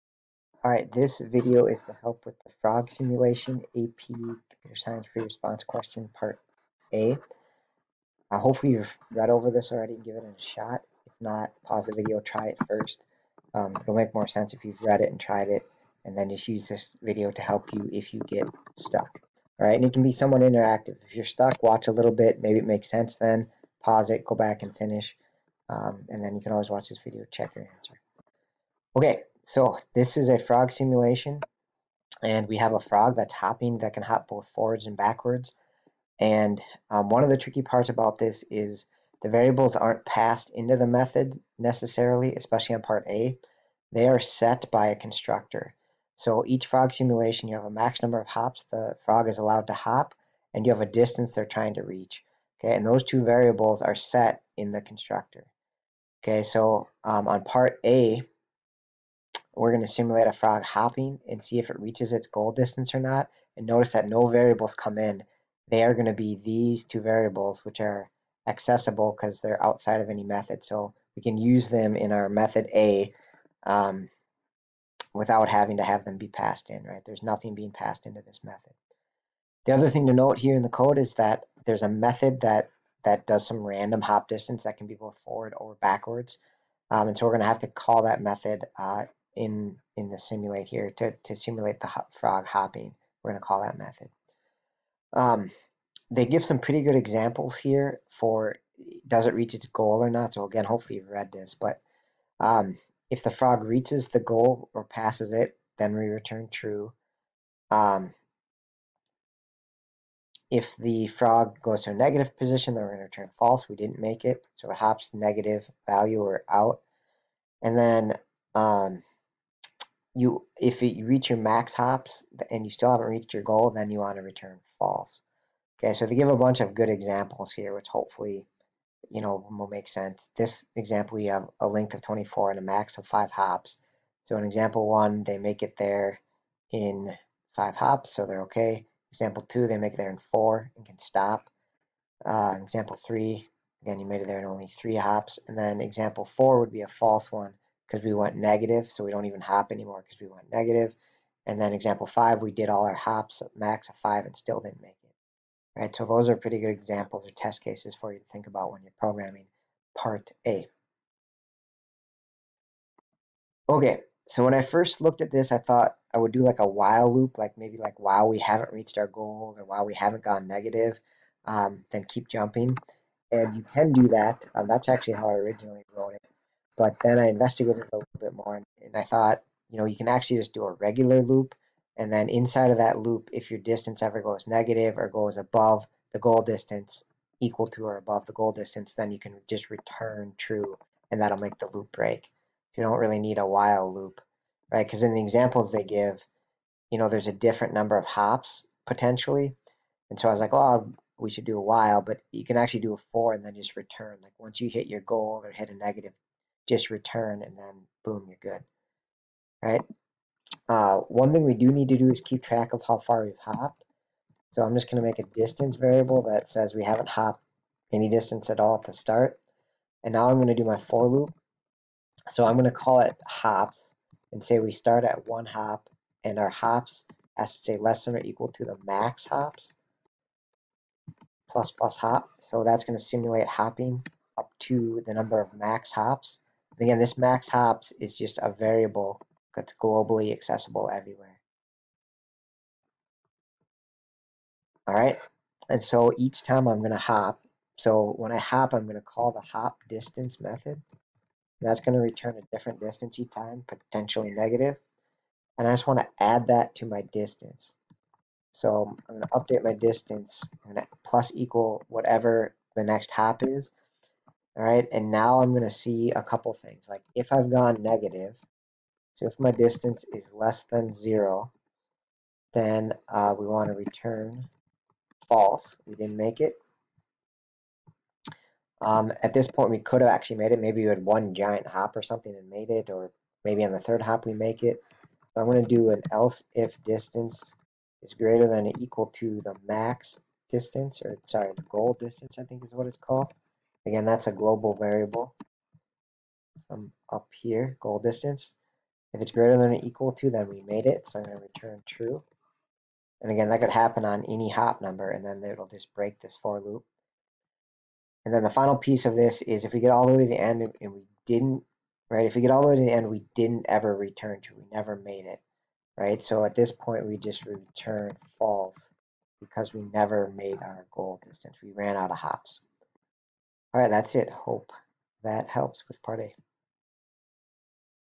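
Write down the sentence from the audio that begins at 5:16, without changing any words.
So at this point, we just return false because we never made our goal distance.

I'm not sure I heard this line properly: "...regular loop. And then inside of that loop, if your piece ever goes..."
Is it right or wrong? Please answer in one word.
wrong.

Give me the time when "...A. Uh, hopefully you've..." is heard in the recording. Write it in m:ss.
0:06.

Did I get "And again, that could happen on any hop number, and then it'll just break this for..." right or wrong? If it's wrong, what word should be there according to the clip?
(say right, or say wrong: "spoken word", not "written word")
right.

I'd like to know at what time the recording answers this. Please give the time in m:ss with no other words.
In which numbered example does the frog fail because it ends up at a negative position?
2:25.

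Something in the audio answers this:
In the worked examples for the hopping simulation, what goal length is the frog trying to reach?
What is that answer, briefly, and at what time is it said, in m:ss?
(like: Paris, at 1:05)
24, at 2:12.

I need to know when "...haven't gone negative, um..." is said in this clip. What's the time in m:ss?
2:49.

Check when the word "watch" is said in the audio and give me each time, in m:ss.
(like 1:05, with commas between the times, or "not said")
0:21, 0:26.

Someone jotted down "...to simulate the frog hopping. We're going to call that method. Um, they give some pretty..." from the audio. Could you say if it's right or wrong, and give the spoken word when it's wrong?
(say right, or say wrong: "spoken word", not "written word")
right.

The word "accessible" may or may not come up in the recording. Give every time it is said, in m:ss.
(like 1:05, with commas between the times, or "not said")
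1:08, 4:00.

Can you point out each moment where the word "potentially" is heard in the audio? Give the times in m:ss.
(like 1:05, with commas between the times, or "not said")
3:18, 4:13.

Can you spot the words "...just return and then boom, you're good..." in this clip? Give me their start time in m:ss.
3:26.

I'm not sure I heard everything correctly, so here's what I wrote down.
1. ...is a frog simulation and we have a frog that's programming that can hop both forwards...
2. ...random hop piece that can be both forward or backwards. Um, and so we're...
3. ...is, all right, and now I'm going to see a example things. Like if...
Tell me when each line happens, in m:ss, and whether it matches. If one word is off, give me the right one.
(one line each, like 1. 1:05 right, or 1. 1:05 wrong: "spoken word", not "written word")
1. 0:30 wrong: "hopping", not "programming"
2. 1:23 wrong: "distance", not "piece"
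3. 4:23 wrong: "couple", not "example".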